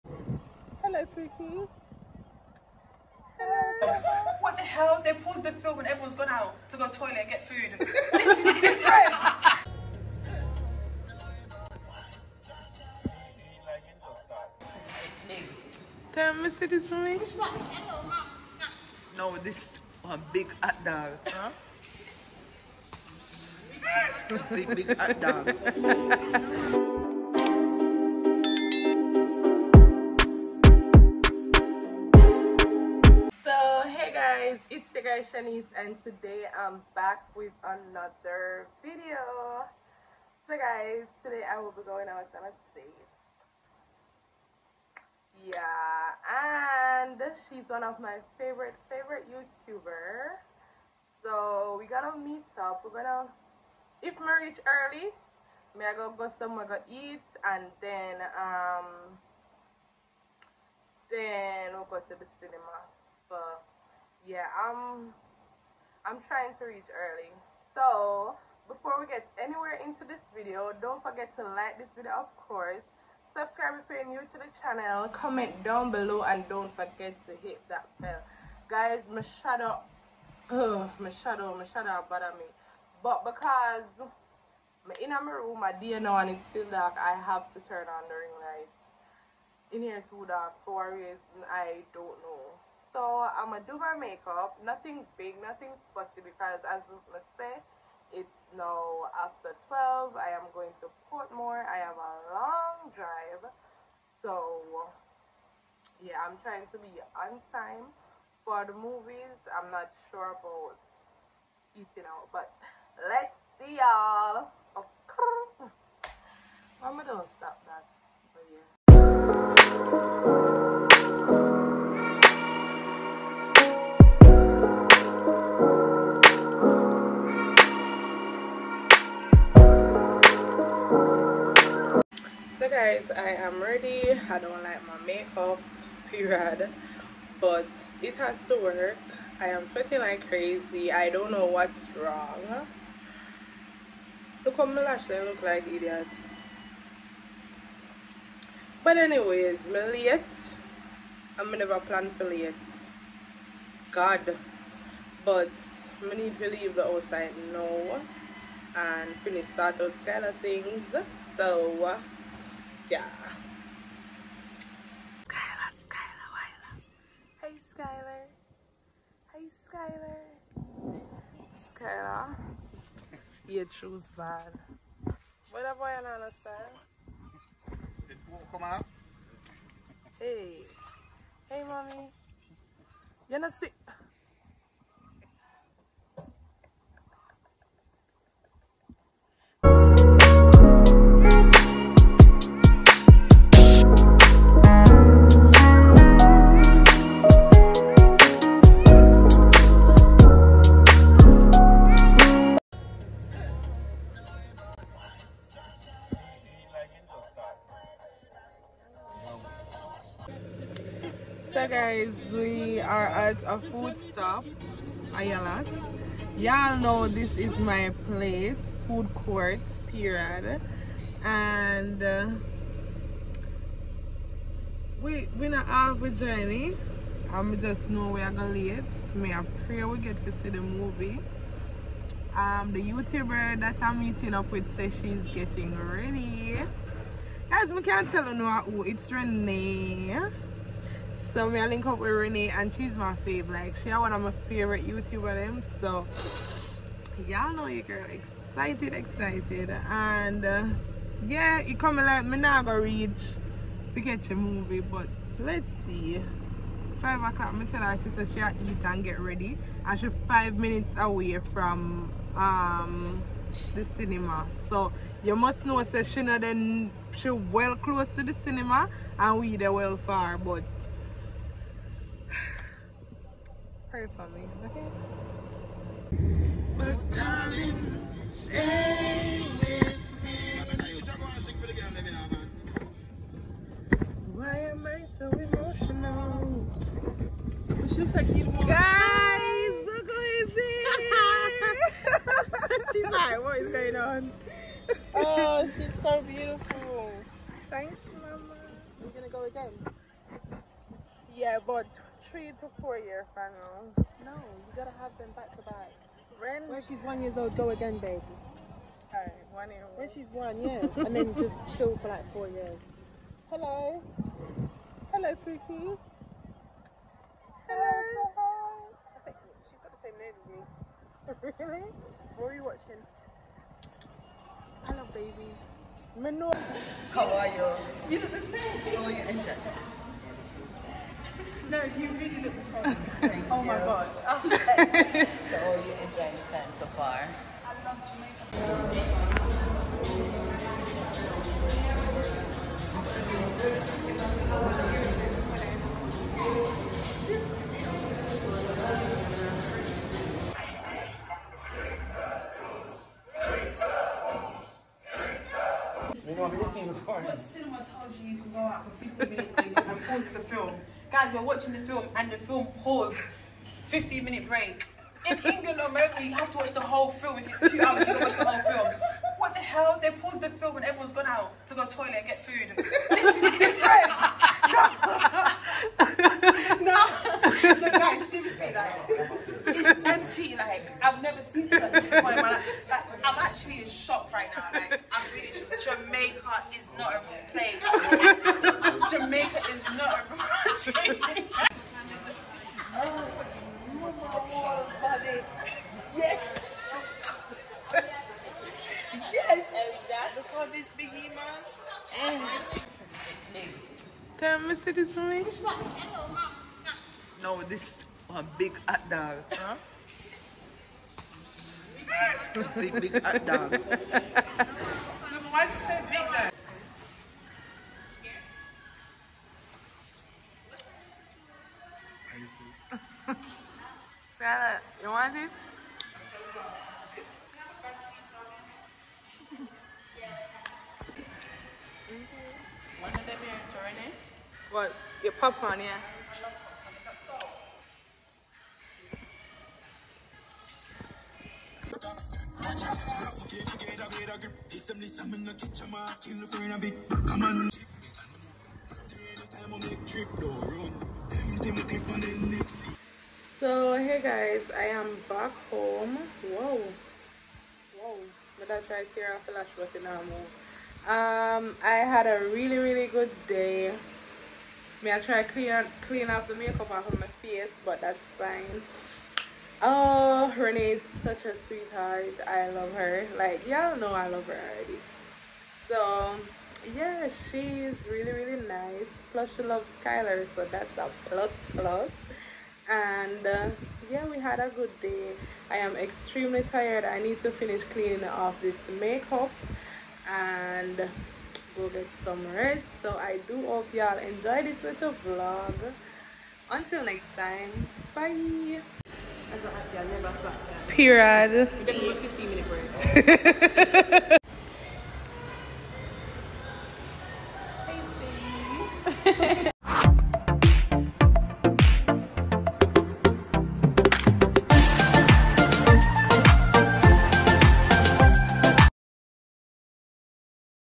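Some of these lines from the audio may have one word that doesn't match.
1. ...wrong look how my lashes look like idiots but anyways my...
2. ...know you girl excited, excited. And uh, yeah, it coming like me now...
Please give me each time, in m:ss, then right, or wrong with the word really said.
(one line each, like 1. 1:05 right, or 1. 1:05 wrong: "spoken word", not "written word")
1. 2:22 right
2. 4:07 right.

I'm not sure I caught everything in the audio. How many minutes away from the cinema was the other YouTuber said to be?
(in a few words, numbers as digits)
5 minutes.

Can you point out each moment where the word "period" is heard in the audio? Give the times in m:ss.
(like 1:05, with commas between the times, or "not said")
2:16, 3:39, 8:20.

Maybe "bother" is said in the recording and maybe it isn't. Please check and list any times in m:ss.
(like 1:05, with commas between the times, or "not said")
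1:22.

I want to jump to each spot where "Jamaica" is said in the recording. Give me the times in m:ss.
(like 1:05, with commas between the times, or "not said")
5:38, 6:25.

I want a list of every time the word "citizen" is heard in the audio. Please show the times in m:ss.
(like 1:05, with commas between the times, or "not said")
0:16.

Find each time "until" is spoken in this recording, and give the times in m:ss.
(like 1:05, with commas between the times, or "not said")
8:16.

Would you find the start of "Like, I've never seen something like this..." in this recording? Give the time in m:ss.
6:20.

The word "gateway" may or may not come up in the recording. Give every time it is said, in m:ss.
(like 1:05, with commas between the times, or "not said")
not said.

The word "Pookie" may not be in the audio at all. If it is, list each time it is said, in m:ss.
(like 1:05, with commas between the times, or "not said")
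0:01, 5:15.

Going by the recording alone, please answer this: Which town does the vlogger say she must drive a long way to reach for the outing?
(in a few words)
Portmore.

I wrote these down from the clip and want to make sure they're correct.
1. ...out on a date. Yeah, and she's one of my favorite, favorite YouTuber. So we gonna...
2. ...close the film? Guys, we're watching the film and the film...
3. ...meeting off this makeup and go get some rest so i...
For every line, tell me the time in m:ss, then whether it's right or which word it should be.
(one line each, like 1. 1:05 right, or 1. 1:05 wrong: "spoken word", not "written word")
1. 0:42 right
2. 6:00 wrong: "pause", not "close"
3. 8:07 wrong: "cleaning", not "meeting".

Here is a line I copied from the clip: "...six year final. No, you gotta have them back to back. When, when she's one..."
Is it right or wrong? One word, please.
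wrong.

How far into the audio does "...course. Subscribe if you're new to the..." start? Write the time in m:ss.
1:12.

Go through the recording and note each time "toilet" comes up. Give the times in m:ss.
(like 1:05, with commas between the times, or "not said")
0:06, 6:11.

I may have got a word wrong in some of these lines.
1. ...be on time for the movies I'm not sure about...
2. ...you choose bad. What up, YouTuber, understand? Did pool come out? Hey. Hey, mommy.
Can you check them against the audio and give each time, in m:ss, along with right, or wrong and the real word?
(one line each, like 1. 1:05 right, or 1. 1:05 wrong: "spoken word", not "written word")
1. 1:46 right
2. 2:53 wrong: "Wyla", not "YouTuber".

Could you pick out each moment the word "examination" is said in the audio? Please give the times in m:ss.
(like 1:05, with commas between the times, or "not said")
not said.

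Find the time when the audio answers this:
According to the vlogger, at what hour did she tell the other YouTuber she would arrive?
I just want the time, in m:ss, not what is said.
4:17.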